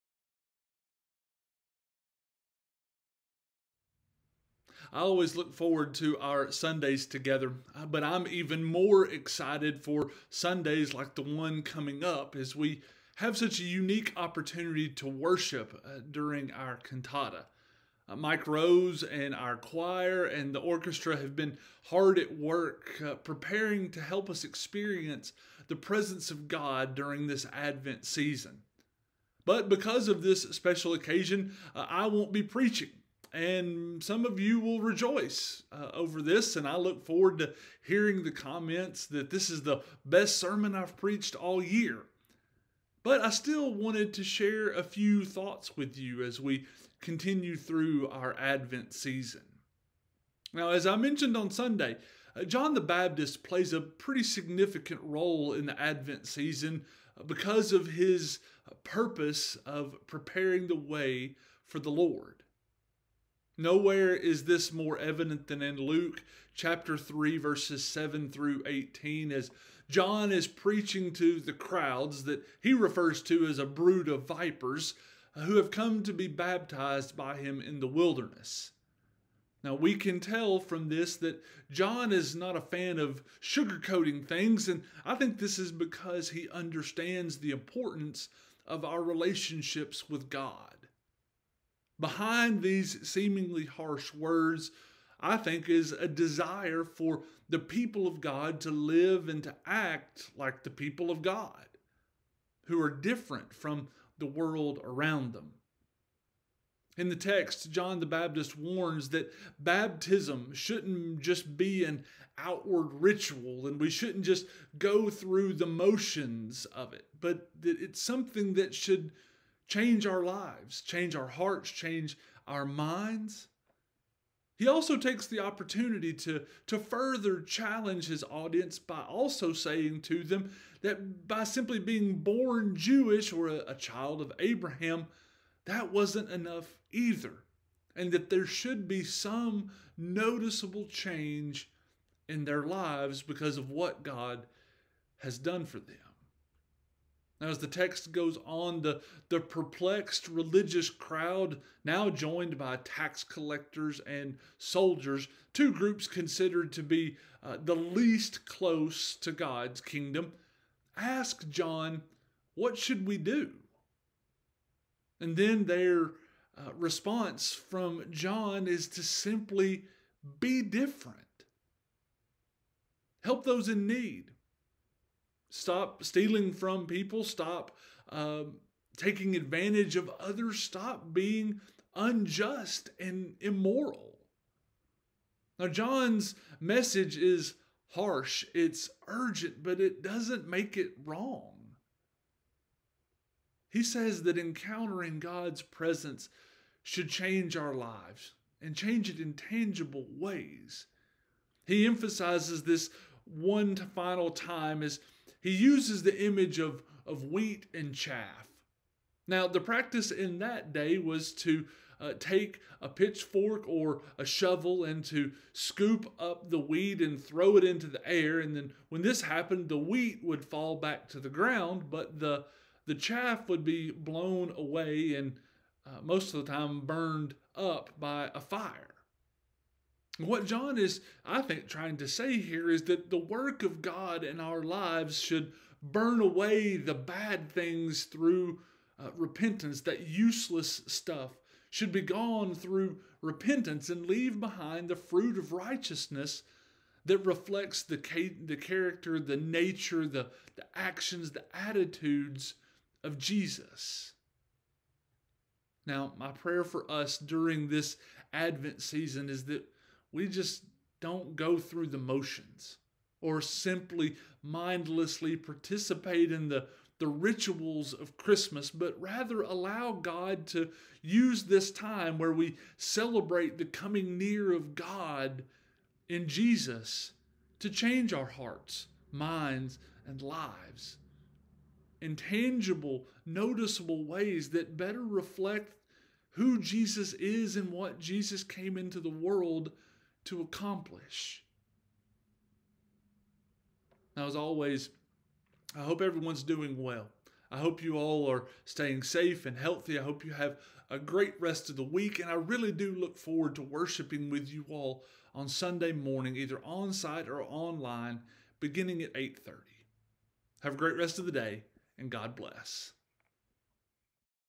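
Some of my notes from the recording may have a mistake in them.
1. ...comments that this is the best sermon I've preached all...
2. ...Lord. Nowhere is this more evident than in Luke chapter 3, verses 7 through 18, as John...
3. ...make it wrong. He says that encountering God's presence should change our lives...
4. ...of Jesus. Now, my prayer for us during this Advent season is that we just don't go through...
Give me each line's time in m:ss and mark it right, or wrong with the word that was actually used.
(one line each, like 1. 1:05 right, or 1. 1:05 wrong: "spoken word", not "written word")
1. 0:38 right
2. 1:01 right
3. 3:10 right
4. 4:13 right.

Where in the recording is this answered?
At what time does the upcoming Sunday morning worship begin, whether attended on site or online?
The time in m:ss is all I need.
5:09.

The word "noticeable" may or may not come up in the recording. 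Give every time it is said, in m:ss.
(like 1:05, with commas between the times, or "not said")
2:19, 4:43.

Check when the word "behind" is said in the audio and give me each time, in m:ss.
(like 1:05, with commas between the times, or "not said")
1:32, 4:04.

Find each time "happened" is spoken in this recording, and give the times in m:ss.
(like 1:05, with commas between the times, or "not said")
3:39.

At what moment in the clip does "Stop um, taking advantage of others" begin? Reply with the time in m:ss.
2:57.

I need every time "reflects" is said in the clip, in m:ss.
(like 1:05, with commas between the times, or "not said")
4:07, 4:45.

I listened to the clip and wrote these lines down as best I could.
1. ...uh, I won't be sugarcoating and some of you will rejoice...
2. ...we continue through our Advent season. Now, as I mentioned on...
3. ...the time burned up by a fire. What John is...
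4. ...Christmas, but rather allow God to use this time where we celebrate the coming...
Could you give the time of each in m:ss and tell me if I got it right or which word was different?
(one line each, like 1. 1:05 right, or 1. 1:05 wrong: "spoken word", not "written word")
1. 0:31 wrong: "preaching", not "sugarcoating"
2. 0:46 right
3. 3:46 right
4. 4:28 right.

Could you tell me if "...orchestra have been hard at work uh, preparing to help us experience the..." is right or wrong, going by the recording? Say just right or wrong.
right.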